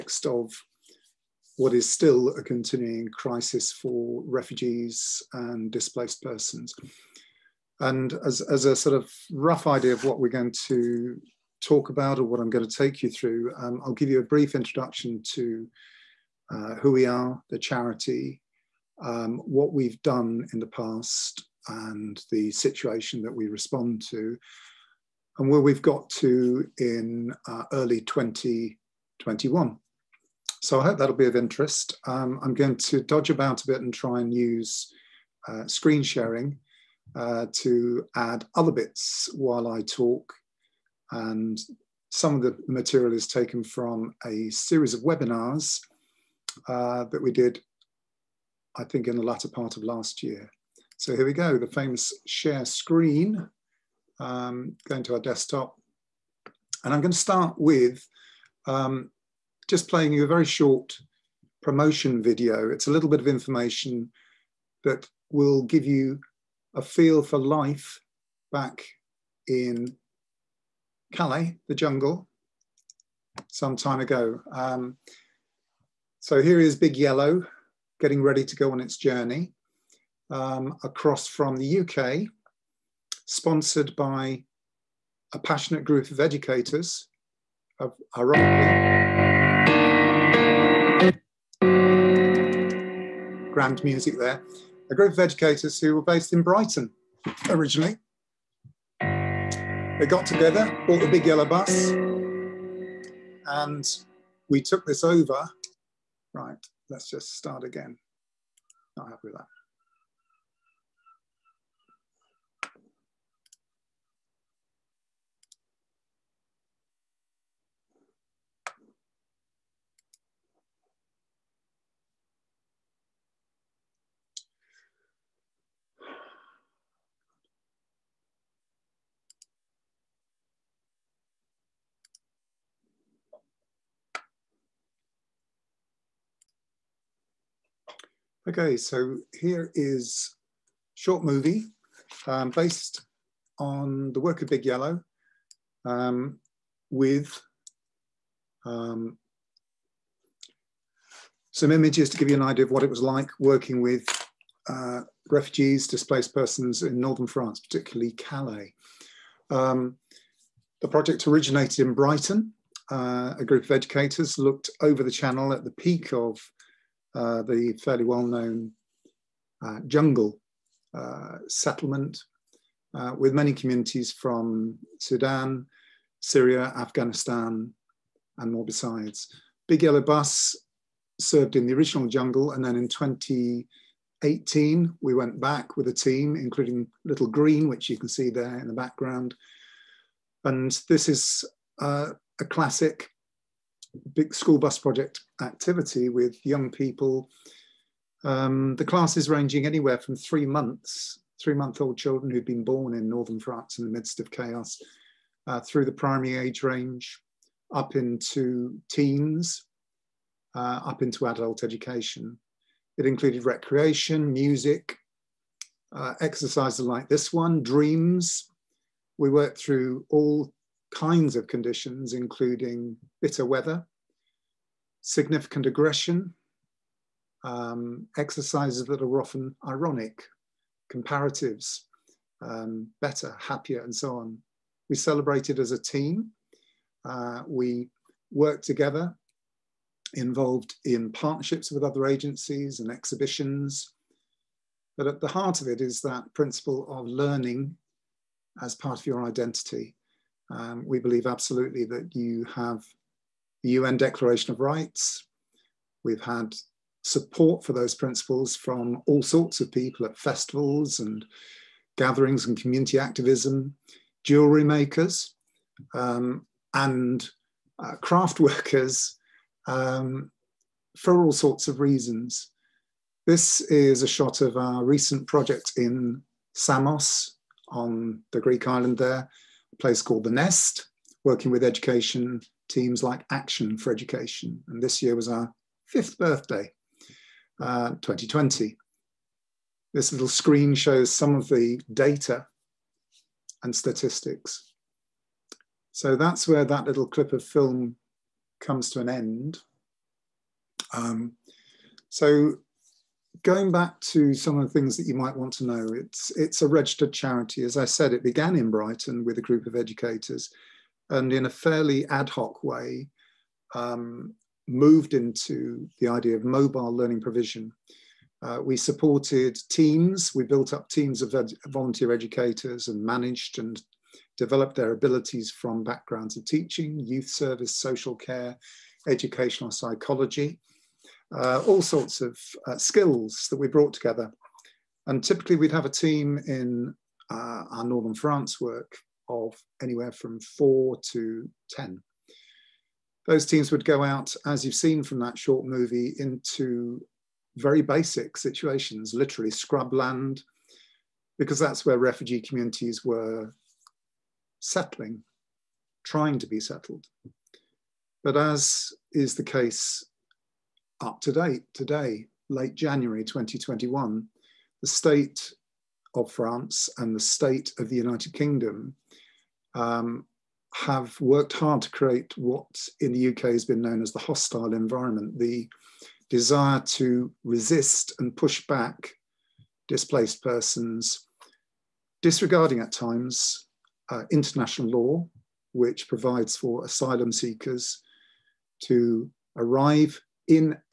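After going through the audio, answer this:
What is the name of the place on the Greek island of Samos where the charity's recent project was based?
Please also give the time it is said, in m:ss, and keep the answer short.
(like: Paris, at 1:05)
The Nest, at 4:40.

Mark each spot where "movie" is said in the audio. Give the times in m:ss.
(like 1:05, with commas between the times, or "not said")
2:21, 5:45.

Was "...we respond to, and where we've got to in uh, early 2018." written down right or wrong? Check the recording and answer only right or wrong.
wrong.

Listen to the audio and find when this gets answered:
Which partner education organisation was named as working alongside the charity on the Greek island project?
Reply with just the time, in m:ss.
4:43.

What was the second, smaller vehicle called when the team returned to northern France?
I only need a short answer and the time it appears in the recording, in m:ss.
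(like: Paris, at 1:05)
Little Green, at 3:07.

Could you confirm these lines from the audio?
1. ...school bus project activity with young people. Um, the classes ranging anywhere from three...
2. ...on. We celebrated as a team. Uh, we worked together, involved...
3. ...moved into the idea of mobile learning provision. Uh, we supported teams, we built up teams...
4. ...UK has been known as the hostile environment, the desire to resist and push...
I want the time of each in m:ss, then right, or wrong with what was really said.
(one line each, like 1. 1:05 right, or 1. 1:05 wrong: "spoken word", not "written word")
1. 3:14 right
2. 3:54 right
3. 5:14 right
4. 6:13 right.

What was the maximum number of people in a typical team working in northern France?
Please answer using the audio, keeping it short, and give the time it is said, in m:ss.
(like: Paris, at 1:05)
10, at 5:41.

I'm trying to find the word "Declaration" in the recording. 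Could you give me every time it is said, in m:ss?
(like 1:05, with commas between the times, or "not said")
4:13.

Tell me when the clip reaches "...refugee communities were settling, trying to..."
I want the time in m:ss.
5:51.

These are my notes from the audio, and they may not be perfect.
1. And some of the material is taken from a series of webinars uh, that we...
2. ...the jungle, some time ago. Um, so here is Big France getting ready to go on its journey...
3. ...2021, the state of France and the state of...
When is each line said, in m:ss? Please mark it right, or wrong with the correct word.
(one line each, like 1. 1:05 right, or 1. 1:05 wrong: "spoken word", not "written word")
1. 0:41 right
2. 1:11 wrong: "Yellow", not "France"
3. 6:03 right.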